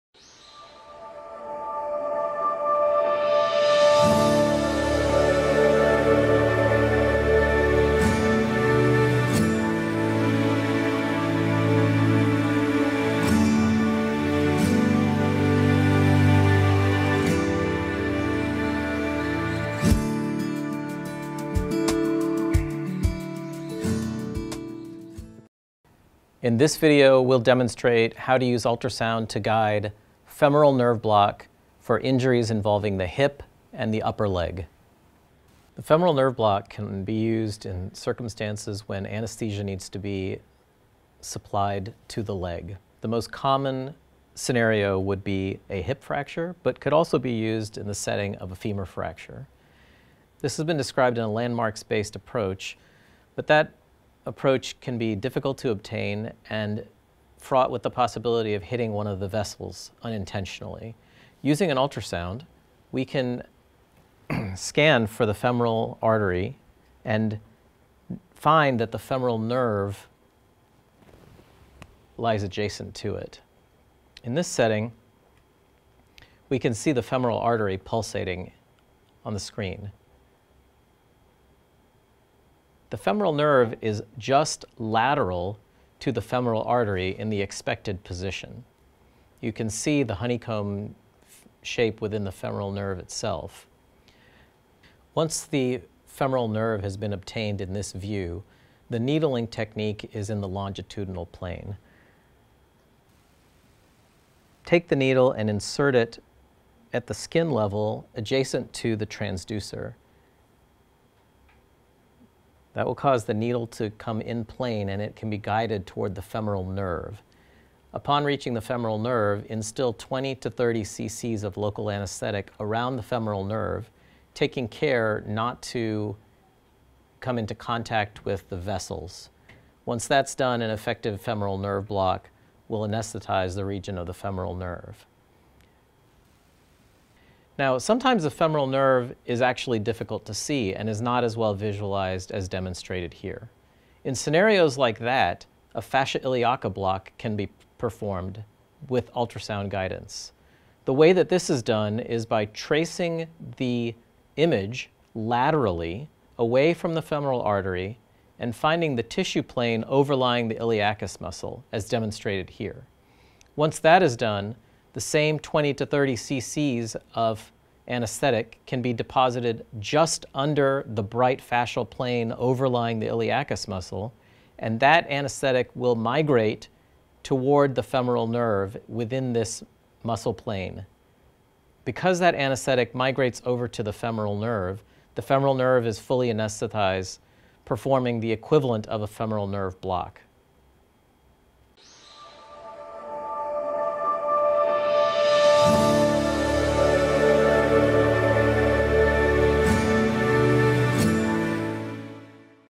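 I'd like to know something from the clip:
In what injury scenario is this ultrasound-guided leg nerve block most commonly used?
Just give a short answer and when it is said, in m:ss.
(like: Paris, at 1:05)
Hip fracture, at 0:45.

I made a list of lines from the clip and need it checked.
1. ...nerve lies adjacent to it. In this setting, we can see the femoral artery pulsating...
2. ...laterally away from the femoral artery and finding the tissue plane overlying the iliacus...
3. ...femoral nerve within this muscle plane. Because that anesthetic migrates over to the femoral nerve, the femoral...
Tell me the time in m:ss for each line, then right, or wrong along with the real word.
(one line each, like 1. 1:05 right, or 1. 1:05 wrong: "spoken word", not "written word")
1. 1:09 right
2. 2:35 right
3. 2:57 right.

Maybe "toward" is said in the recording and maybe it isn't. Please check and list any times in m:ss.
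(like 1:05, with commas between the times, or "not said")
1:55, 2:57.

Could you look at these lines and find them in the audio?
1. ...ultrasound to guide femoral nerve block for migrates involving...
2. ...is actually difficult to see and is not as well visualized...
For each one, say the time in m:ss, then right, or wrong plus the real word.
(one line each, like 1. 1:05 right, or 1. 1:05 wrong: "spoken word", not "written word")
1. 0:28 wrong: "injuries", not "migrates"
2. 2:19 right.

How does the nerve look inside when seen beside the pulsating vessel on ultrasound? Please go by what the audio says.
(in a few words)
Honeycomb shape.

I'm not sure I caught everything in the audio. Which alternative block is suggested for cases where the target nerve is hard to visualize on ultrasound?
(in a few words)
Fascia iliaca block.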